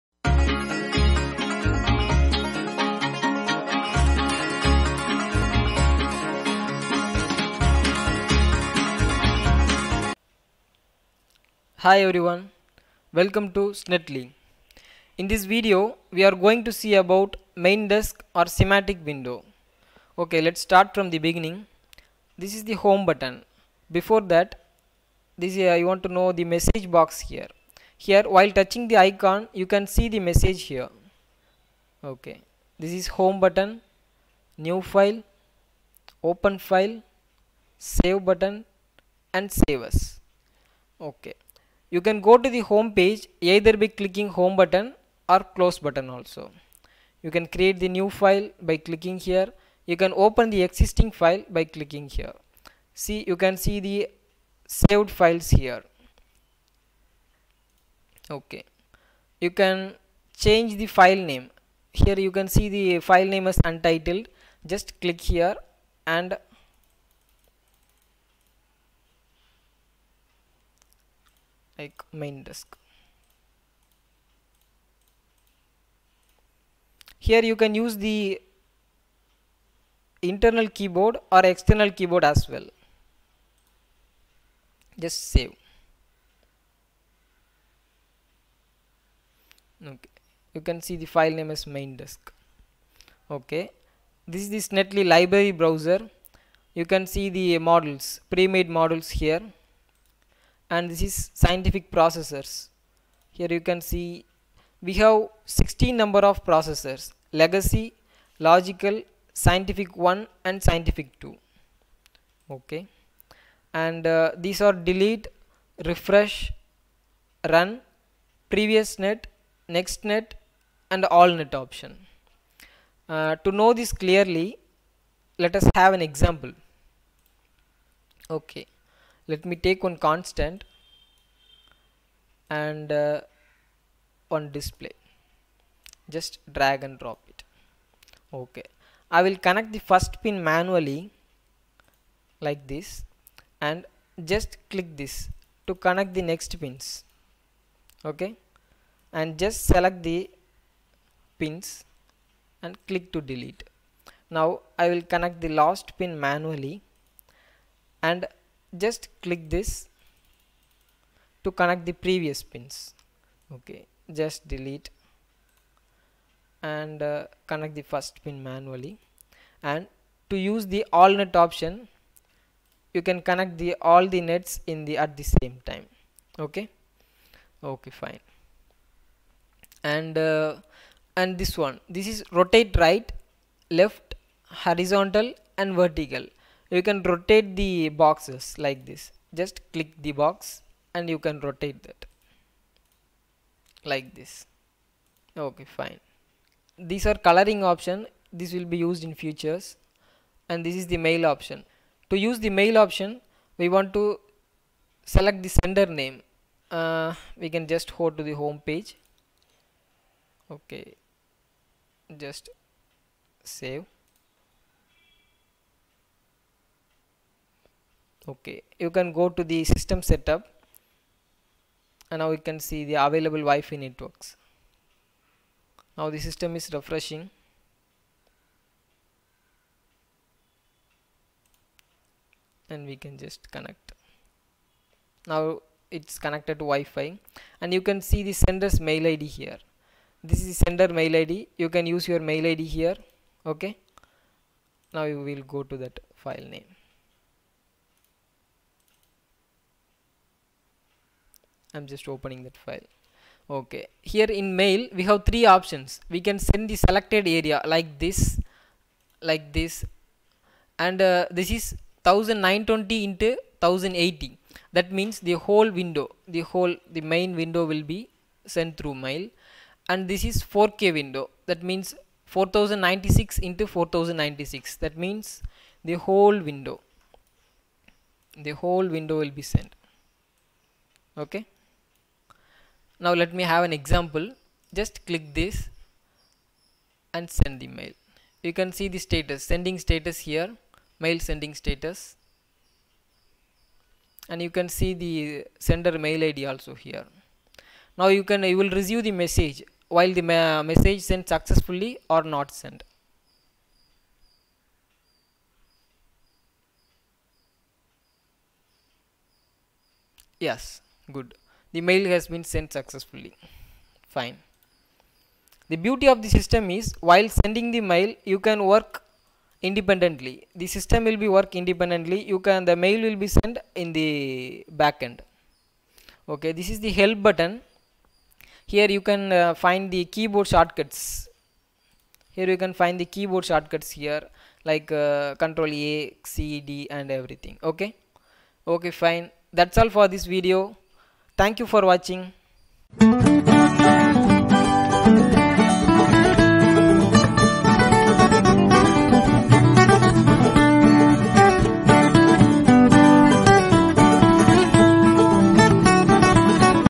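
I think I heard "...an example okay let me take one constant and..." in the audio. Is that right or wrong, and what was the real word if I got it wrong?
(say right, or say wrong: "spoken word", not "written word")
right.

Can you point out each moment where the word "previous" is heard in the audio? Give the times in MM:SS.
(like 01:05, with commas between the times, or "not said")
01:58, 02:41.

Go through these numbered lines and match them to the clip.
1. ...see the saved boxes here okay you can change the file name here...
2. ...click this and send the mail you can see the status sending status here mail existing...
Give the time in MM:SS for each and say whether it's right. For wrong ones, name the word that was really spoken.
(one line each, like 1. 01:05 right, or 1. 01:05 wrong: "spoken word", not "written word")
1. 00:53 wrong: "files", not "boxes"
2. 04:45 wrong: "sending", not "existing".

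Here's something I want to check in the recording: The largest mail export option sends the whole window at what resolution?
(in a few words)
4096 x 4096.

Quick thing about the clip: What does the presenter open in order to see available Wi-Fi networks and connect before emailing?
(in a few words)
system setup.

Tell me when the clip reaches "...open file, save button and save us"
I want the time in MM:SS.
00:36.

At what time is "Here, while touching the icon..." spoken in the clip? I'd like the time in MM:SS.
00:27.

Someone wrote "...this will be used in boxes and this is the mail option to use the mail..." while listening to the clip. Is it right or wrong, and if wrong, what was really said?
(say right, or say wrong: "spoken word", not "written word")
wrong: "futures", not "boxes".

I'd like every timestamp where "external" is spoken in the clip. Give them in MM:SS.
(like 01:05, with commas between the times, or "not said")
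01:21.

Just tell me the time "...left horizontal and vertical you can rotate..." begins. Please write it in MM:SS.
03:03.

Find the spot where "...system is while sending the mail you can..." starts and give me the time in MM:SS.
05:16.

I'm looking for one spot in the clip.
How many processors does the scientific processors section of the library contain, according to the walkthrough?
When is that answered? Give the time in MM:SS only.
01:45.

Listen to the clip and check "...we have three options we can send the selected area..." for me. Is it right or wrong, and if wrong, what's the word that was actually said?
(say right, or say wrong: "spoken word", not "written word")
right.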